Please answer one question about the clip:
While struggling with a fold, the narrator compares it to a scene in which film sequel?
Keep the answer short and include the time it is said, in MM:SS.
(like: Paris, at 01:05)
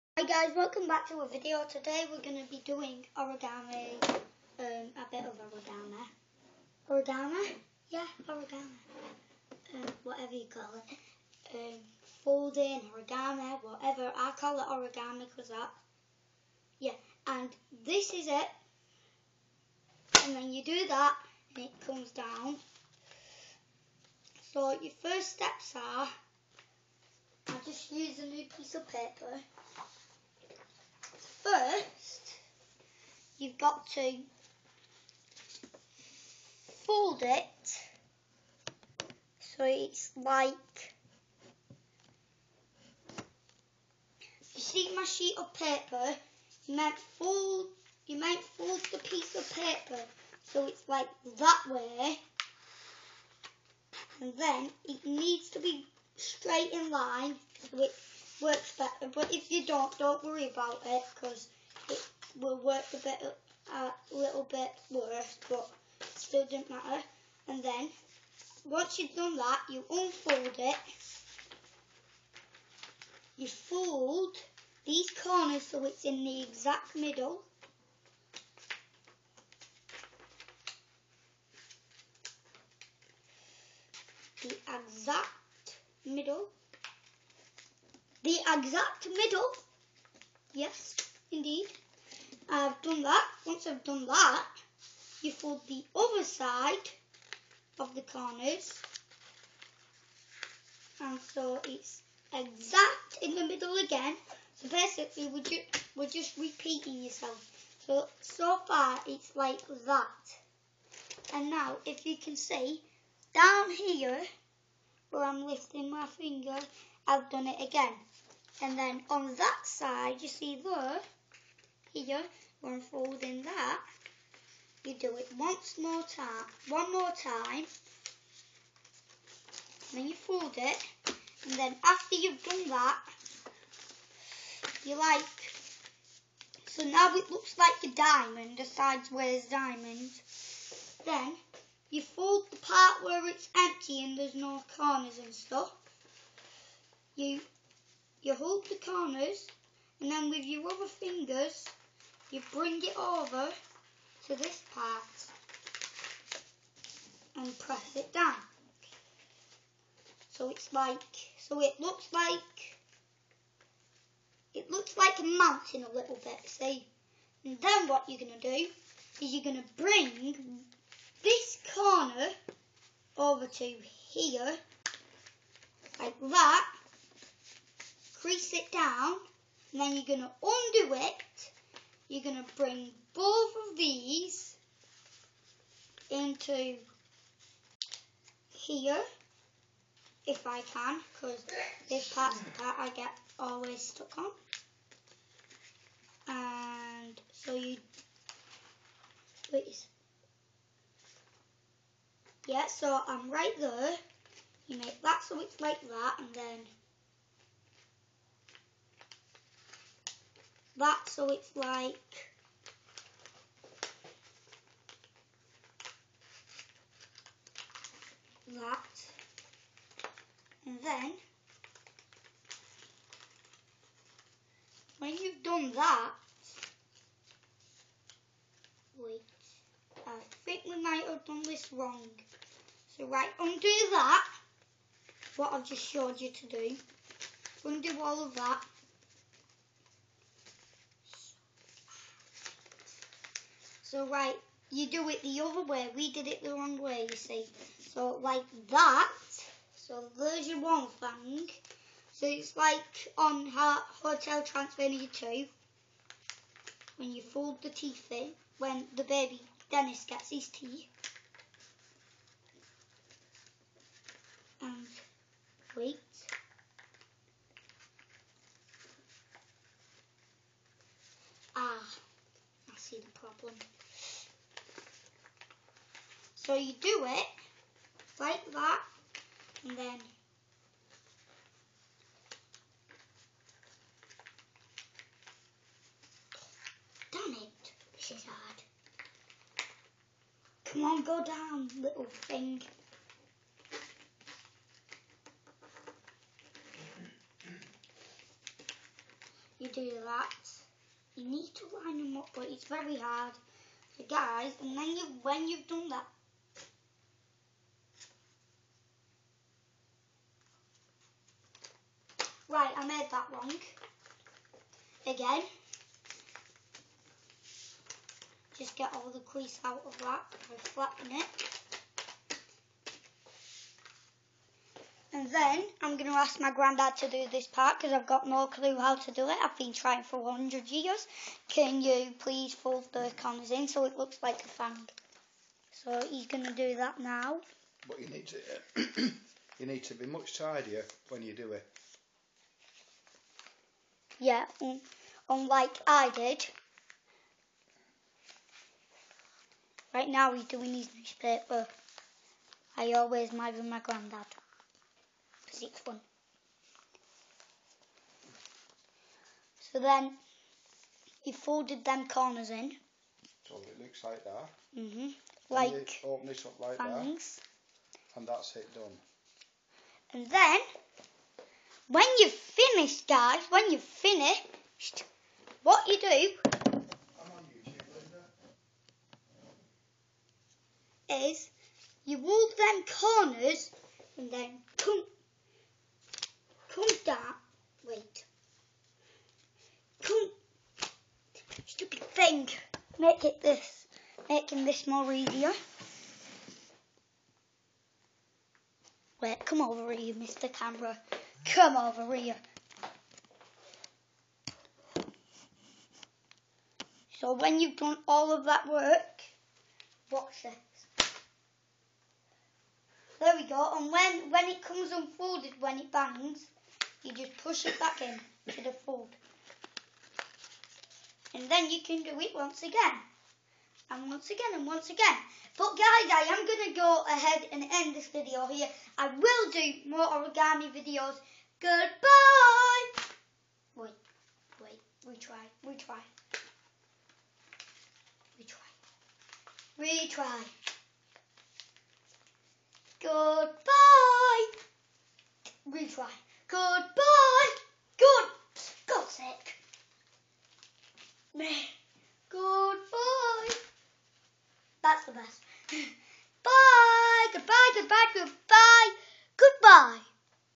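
Hotel Transylvania 2, at 04:14.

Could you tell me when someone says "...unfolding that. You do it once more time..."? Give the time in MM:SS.
02:02.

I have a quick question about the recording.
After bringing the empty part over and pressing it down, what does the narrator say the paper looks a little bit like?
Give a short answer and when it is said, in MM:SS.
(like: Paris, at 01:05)
A mountain, at 02:45.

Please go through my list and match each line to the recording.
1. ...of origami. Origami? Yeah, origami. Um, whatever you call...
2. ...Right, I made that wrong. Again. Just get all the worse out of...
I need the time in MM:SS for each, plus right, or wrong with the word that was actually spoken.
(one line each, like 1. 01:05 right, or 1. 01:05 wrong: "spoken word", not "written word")
1. 00:05 right
2. 05:12 wrong: "crease", not "worse".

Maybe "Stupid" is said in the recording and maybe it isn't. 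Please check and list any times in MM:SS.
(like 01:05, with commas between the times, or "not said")
06:31.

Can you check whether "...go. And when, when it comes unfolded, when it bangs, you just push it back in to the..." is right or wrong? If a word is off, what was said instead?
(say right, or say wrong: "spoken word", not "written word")
right.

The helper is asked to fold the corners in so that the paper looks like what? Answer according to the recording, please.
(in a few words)
A fang.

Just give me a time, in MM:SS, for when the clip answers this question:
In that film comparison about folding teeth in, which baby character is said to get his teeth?
04:19.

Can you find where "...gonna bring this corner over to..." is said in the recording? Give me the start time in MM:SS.
02:49.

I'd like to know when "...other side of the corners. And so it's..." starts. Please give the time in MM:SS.
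01:35.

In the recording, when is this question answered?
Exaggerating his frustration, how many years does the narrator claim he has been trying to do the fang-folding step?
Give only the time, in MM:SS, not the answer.
05:30.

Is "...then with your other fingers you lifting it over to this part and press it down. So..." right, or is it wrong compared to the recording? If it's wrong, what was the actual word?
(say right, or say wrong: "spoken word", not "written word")
wrong: "bring", not "lifting".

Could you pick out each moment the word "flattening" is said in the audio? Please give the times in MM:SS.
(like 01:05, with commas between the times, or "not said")
05:20.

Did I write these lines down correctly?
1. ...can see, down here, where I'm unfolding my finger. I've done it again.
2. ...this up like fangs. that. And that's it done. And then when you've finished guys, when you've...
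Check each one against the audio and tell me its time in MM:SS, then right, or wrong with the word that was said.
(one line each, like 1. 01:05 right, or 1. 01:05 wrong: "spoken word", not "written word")
1. 01:52 wrong: "lifting", not "unfolding"
2. 06:06 right.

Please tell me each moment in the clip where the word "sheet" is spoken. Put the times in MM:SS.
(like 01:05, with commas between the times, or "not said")
00:45.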